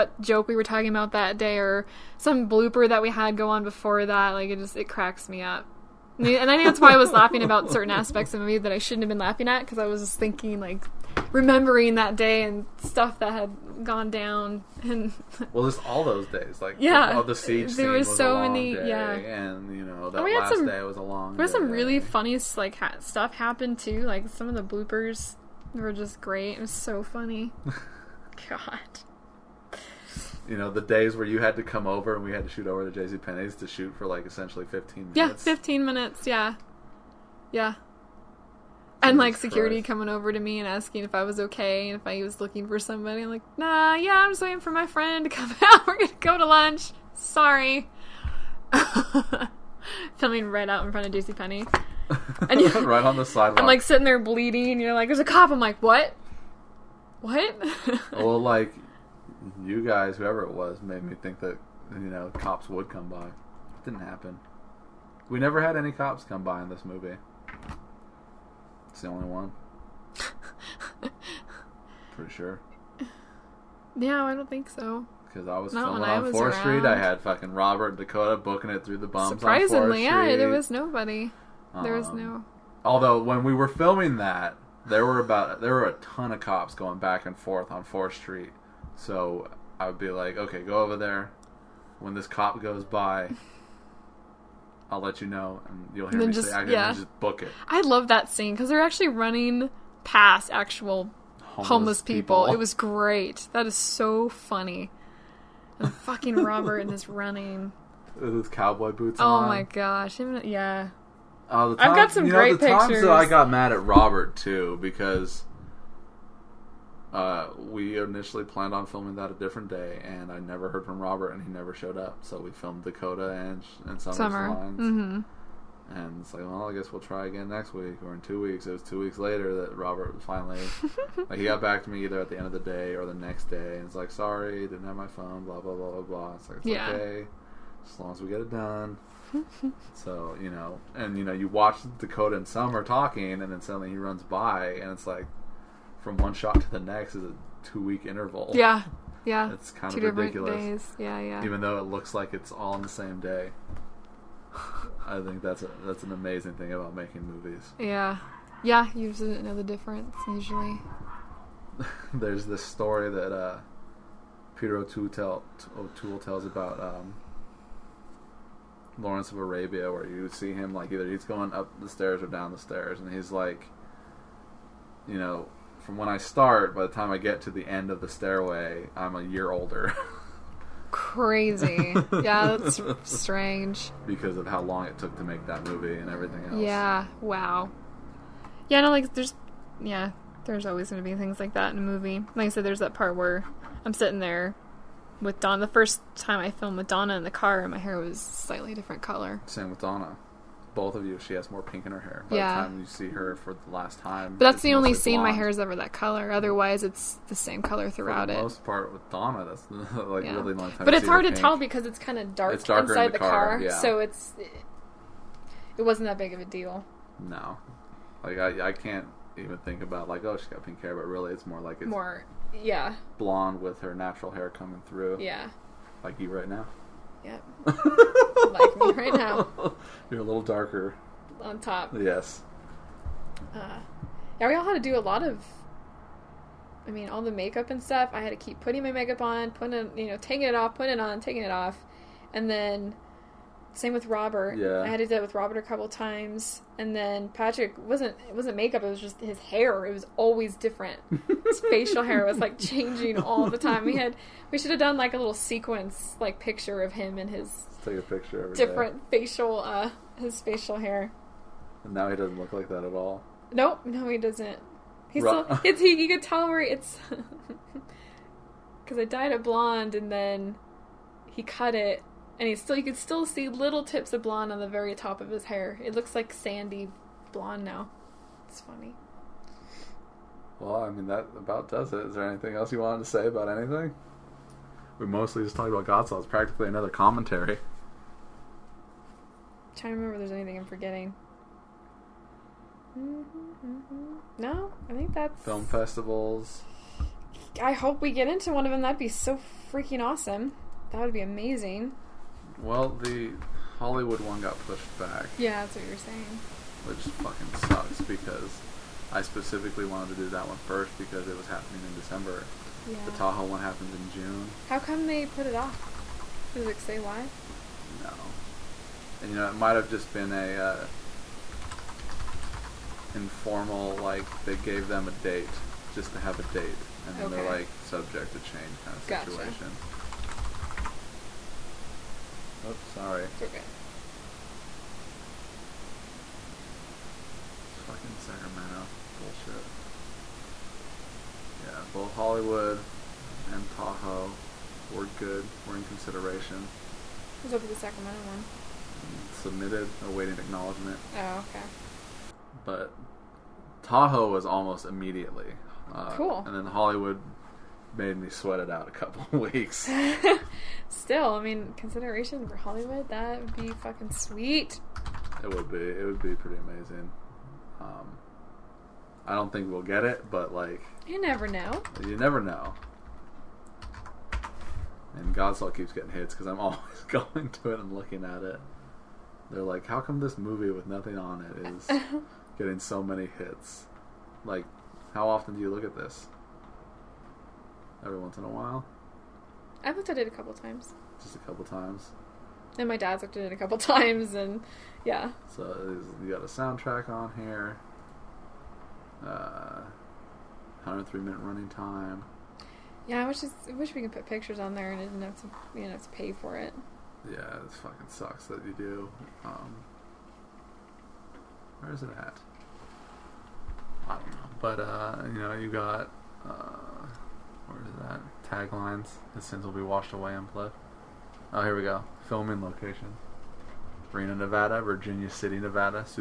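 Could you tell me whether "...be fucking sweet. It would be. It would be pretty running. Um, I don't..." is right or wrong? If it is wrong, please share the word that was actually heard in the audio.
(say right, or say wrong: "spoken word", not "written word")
wrong: "amazing", not "running".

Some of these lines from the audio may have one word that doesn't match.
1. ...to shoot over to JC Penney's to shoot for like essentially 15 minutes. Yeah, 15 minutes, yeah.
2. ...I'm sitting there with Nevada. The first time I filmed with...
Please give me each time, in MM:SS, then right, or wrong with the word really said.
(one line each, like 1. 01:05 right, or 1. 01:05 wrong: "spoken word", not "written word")
1. 00:32 right
2. 03:13 wrong: "Donna", not "Nevada".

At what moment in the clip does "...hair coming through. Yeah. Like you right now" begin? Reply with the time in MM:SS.
03:44.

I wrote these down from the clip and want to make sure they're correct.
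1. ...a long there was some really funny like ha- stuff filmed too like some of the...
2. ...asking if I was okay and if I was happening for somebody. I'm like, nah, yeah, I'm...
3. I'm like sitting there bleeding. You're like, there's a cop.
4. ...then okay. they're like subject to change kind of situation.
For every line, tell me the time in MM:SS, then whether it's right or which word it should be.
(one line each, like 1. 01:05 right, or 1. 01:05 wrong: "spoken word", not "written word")
1. 00:20 wrong: "happened", not "filmed"
2. 00:40 wrong: "looking", not "happening"
3. 00:53 right
4. 05:27 right.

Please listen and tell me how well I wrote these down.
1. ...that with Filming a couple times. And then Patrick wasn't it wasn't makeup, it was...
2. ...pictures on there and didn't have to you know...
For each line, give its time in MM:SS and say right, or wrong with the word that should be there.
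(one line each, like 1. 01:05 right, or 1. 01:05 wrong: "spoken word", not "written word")
1. 04:05 wrong: "Robert", not "Filming"
2. 06:44 right.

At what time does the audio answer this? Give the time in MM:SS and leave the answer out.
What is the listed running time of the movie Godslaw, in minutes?
06:40.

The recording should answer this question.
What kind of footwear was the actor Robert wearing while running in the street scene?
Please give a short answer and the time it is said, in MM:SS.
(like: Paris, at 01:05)
Cowboy boots, at 01:48.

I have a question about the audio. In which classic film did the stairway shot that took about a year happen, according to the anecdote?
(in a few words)
Lawrence of Arabia.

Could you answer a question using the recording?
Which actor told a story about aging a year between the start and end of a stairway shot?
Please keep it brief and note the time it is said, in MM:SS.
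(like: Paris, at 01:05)
Peter O'Toole, at 02:44.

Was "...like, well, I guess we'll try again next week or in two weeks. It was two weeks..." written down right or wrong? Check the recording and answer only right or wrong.
right.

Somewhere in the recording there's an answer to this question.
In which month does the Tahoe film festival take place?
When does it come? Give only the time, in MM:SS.
05:14.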